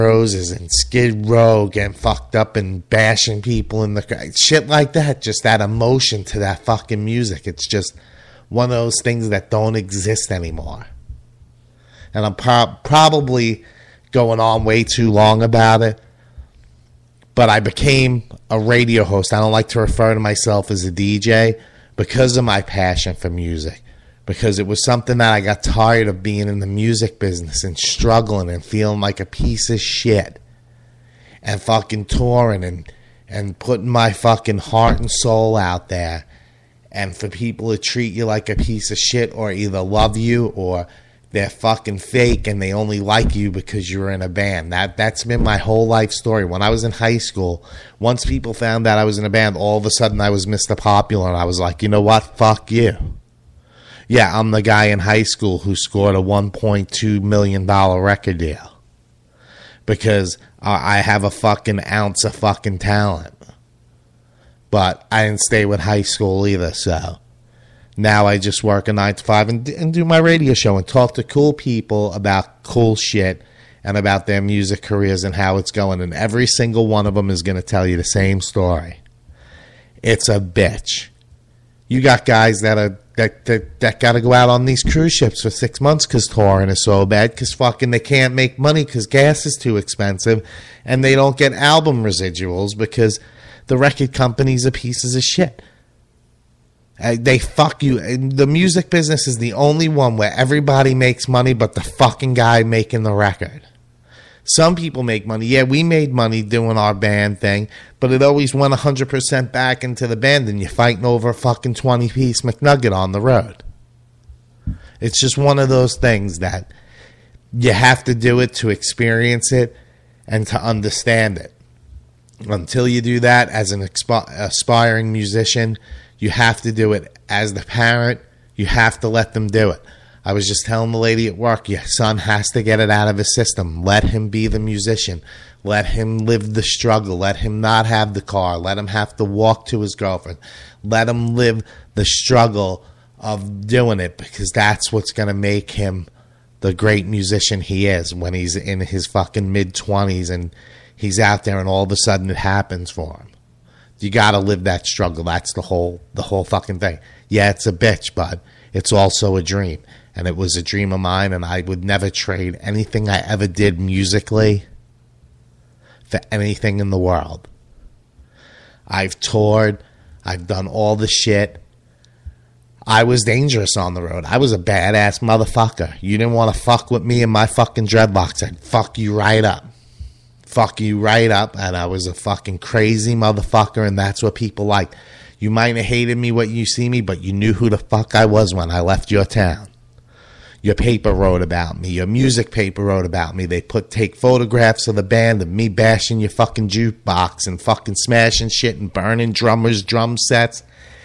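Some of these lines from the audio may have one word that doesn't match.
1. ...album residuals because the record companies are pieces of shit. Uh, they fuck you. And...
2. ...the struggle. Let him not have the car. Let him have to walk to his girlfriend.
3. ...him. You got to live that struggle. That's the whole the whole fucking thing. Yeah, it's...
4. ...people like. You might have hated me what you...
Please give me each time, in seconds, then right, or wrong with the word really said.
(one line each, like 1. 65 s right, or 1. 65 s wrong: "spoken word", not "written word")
1. 91 s right
2. 136 s right
3. 153 s right
4. 184 s right.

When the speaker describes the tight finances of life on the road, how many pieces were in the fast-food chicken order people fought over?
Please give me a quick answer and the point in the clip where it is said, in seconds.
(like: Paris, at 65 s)
20, at 111 s.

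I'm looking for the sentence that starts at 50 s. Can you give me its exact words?
Popular and I was like, you know what?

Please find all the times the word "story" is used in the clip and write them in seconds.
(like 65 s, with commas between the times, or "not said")
46 s, 78 s.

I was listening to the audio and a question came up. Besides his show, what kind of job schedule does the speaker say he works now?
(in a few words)
9 to 5.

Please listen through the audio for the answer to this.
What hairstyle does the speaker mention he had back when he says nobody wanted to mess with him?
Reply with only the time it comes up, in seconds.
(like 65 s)
177 s.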